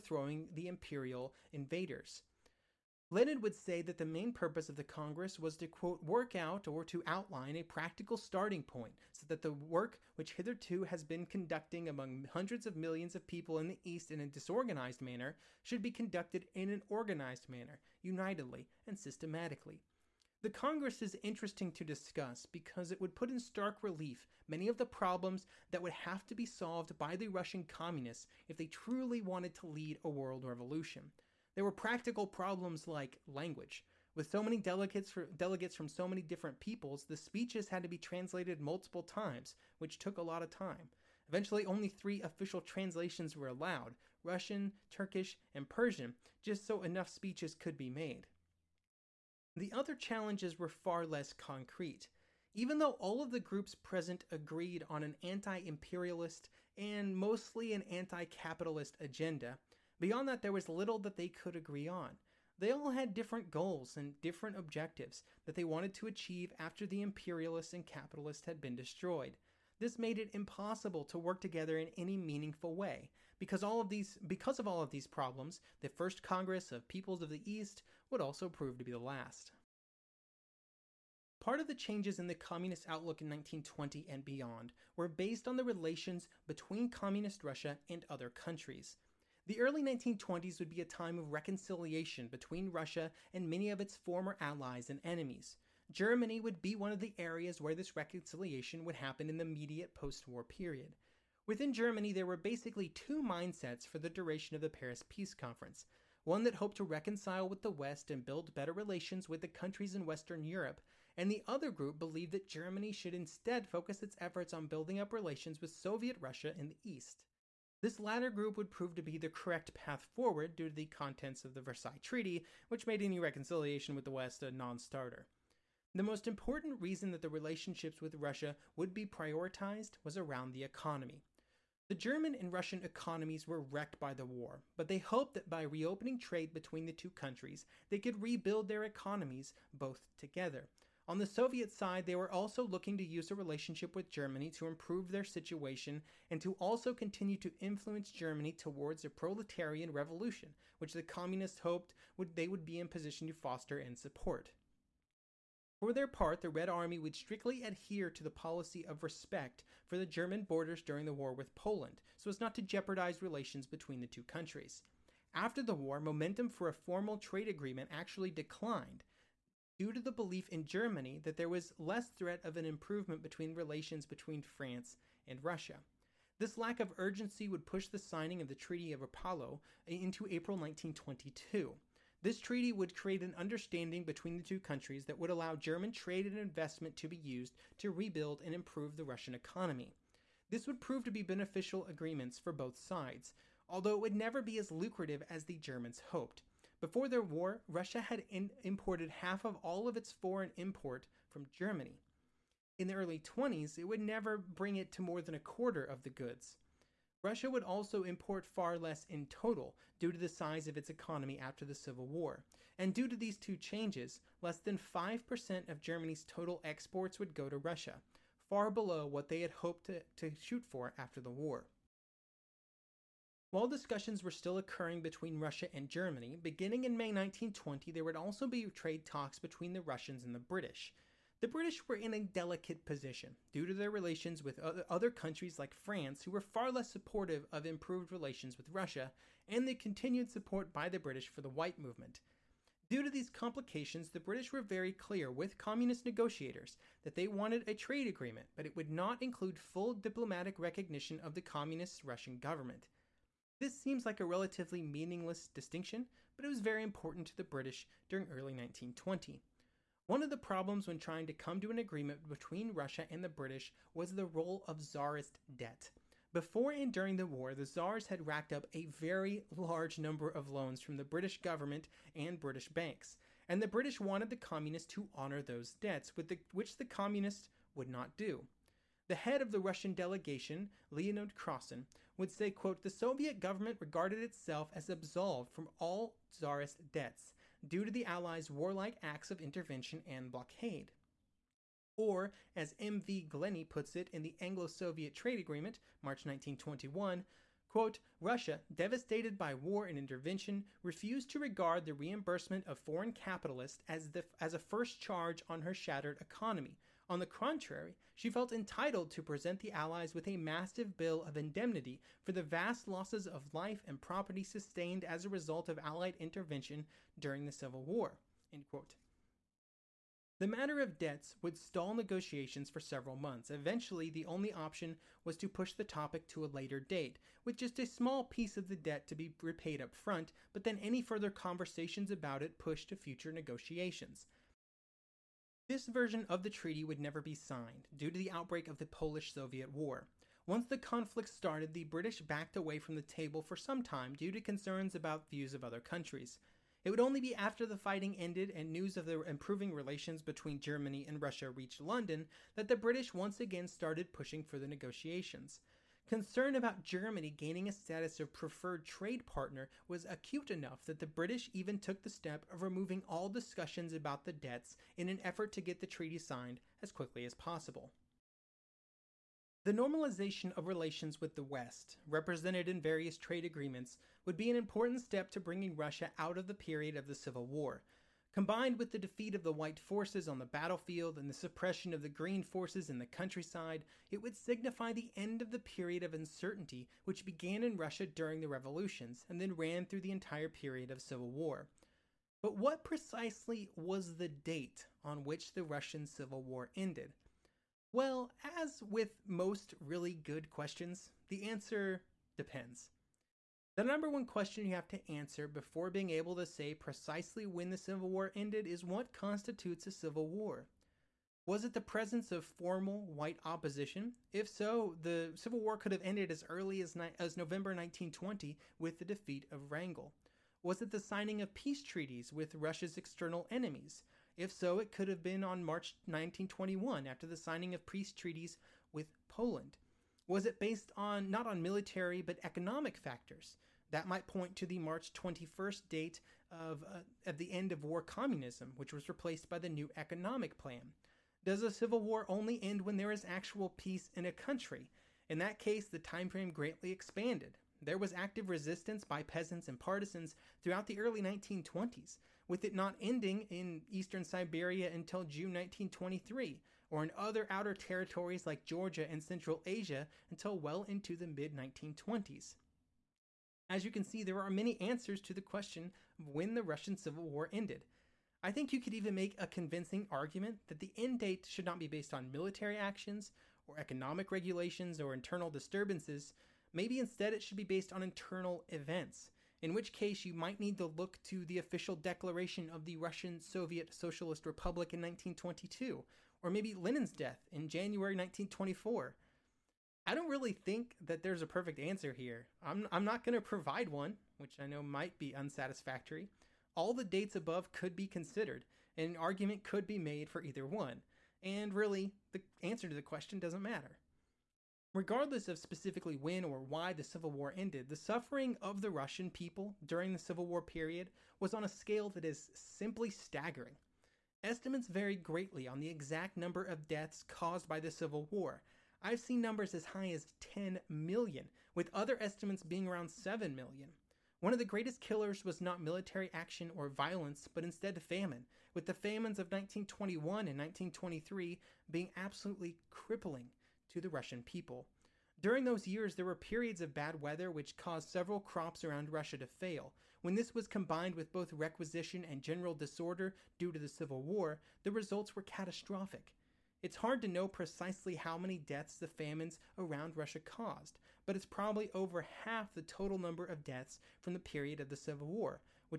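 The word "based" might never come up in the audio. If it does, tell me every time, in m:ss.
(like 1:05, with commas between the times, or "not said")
1:25, 7:10, 7:51, 7:57.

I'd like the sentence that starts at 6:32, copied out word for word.
But what precisely was the date on which the Russian Civil War ended?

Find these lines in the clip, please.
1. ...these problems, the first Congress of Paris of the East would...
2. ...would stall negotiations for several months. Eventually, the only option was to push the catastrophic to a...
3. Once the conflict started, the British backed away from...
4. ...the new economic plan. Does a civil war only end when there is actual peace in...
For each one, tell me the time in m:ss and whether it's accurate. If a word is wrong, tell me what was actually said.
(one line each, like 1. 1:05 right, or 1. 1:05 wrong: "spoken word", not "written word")
1. 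1:14 wrong: "Peoples", not "Paris"
2. 5:21 wrong: "topic", not "catastrophic"
3. 5:40 right
4. 7:19 right.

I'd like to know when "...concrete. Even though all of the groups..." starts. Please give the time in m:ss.
0:51.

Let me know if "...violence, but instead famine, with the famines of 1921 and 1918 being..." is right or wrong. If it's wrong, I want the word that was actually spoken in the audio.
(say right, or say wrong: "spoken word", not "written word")
wrong: "1923", not "1918".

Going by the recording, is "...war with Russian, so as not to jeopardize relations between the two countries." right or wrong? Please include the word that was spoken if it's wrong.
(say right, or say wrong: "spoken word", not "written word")
wrong: "Poland", not "Russian".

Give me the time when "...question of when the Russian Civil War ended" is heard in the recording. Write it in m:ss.
7:45.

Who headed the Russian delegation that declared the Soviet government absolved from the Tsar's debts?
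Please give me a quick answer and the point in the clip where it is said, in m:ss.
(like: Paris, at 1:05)
Leonid Krasin, at 4:40.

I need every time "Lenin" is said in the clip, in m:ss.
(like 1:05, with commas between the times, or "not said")
0:03, 8:06.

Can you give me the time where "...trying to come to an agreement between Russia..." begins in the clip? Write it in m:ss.
4:20.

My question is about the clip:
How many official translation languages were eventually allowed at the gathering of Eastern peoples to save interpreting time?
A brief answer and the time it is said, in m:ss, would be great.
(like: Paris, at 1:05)
3, at 0:41.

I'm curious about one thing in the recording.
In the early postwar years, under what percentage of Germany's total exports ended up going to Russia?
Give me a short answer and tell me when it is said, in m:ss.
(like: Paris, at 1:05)
5%, at 3:34.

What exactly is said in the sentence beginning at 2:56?
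This lack of urgency would push the signing of the Treaty of Rapallo into April 1922.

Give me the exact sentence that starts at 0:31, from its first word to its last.
There were practical problems like language.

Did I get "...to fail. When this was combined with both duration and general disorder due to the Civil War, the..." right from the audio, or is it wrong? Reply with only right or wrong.
wrong.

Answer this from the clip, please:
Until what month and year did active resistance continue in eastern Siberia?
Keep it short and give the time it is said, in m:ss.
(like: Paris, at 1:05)
June 1923, at 7:35.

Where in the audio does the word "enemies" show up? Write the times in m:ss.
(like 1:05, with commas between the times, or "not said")
1:35, 7:03.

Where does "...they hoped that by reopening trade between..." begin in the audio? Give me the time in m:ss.
2:14.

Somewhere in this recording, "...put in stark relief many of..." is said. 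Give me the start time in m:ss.
0:23.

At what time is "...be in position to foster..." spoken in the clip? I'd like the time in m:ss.
2:32.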